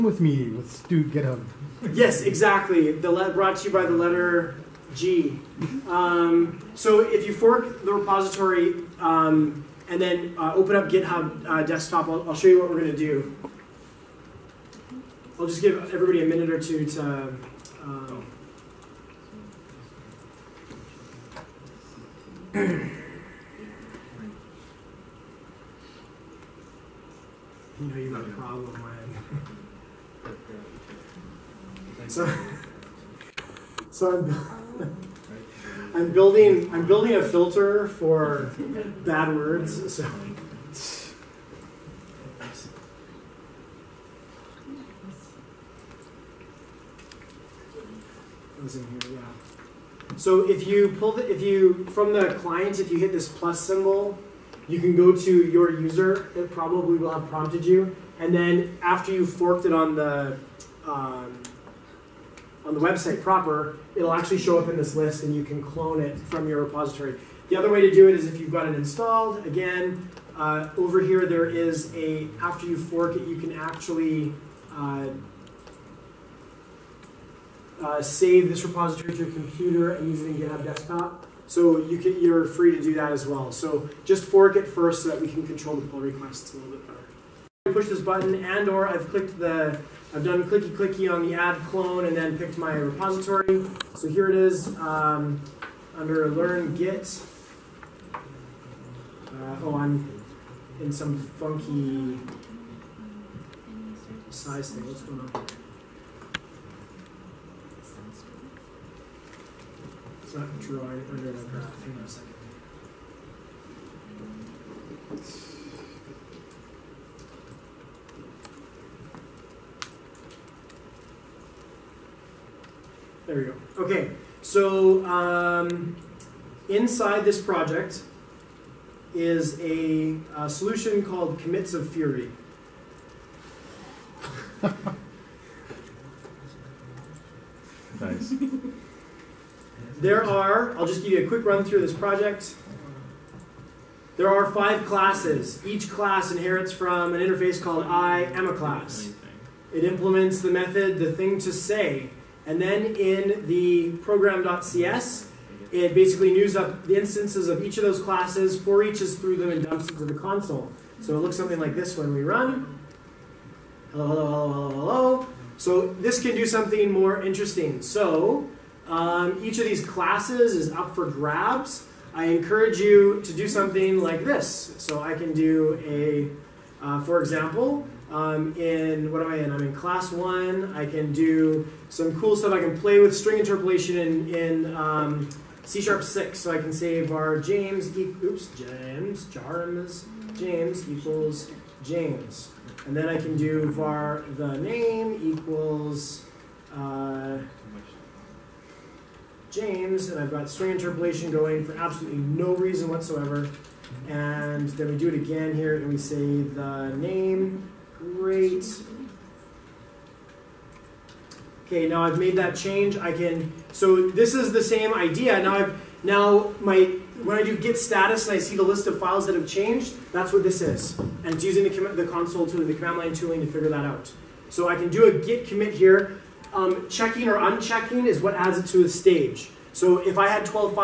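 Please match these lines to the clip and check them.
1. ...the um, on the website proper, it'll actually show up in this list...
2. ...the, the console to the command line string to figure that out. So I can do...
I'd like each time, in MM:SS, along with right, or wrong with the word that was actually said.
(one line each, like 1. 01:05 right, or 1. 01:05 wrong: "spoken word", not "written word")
1. 00:59 right
2. 03:41 wrong: "tooling", not "string".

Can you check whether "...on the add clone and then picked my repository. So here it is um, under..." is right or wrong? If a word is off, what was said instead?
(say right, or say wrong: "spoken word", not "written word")
right.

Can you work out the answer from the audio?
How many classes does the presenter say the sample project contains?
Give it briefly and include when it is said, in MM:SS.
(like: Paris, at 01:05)
5, at 02:24.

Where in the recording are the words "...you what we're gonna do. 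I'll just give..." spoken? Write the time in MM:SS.
00:12.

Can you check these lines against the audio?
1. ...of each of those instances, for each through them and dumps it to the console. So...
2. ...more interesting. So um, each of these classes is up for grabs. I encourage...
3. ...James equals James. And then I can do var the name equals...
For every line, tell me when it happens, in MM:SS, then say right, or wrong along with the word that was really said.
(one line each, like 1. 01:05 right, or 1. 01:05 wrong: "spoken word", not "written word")
1. 02:37 wrong: "classes", not "instances"
2. 02:46 right
3. 03:10 right.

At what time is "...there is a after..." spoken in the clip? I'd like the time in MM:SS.
01:11.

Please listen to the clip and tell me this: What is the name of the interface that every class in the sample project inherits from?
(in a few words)
I am a class.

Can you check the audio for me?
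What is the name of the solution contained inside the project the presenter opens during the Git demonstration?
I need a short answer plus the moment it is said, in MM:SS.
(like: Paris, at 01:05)
Commits of Fury, at 02:11.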